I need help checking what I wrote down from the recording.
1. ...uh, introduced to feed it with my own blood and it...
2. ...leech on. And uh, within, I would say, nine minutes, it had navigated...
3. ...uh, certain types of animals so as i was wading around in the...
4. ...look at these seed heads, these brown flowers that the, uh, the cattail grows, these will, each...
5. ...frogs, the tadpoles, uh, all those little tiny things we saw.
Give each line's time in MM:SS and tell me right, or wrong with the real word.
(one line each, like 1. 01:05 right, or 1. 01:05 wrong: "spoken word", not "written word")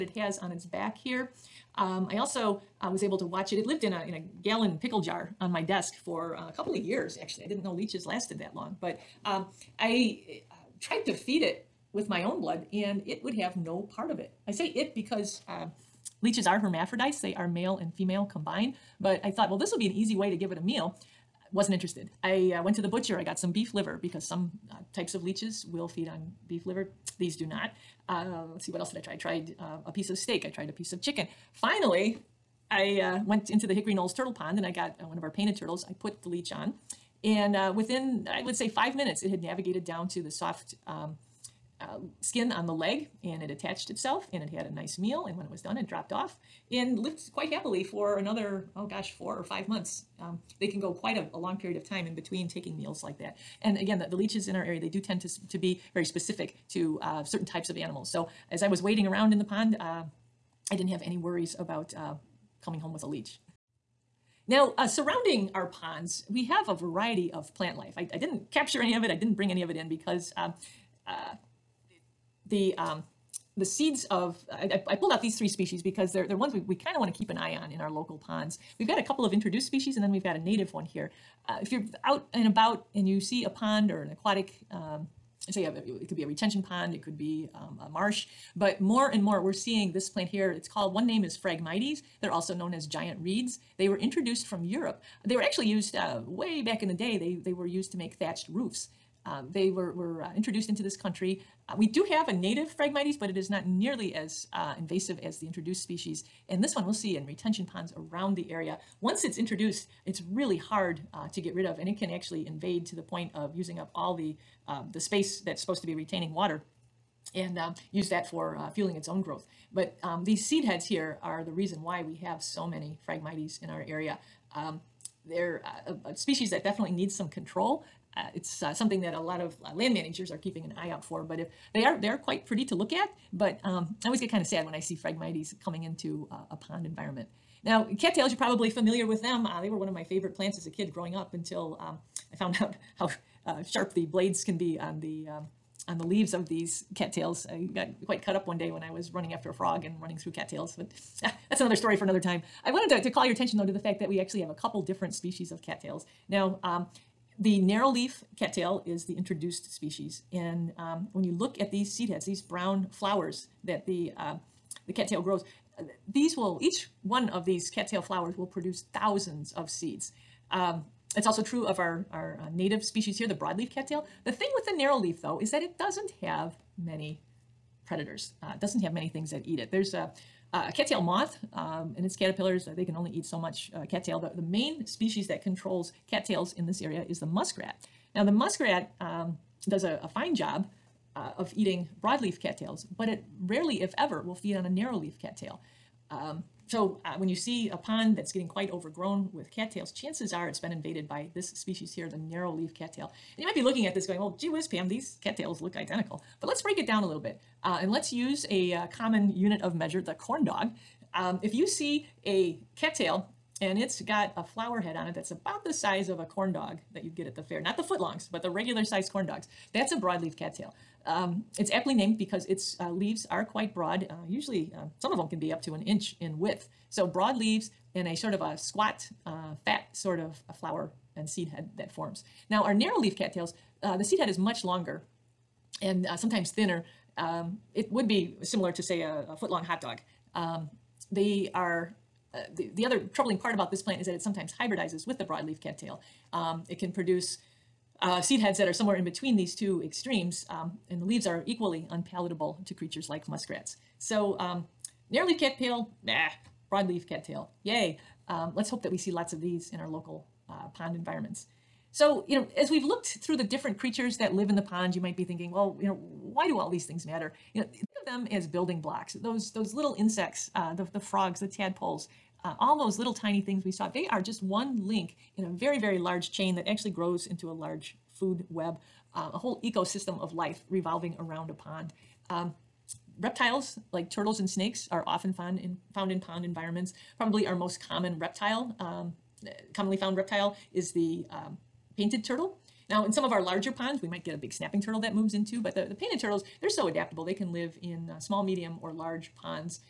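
1. 00:10 wrong: "tried", not "introduced"
2. 00:36 wrong: "five", not "nine"
3. 00:57 right
4. 02:41 right
5. 04:30 right.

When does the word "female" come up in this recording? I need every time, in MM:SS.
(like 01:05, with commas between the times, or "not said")
00:17.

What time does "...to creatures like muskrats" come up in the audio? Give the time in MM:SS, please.
04:12.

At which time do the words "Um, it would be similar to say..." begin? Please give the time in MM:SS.
03:57.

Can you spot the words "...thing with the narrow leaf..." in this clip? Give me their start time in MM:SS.
02:54.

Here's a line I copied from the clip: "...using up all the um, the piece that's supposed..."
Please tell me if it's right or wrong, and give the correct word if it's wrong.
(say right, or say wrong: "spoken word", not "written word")
wrong: "space", not "piece".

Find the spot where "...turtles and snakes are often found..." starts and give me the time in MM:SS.
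04:44.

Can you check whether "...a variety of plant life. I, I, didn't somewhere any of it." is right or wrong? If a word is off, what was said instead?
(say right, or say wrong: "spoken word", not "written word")
wrong: "capture", not "somewhere".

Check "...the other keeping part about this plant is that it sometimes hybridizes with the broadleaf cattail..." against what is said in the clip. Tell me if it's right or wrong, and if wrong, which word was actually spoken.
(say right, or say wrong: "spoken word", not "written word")
wrong: "troubling", not "keeping".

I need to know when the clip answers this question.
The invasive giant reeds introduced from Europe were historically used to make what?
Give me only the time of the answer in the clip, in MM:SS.
01:38.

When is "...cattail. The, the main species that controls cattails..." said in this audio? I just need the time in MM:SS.
03:03.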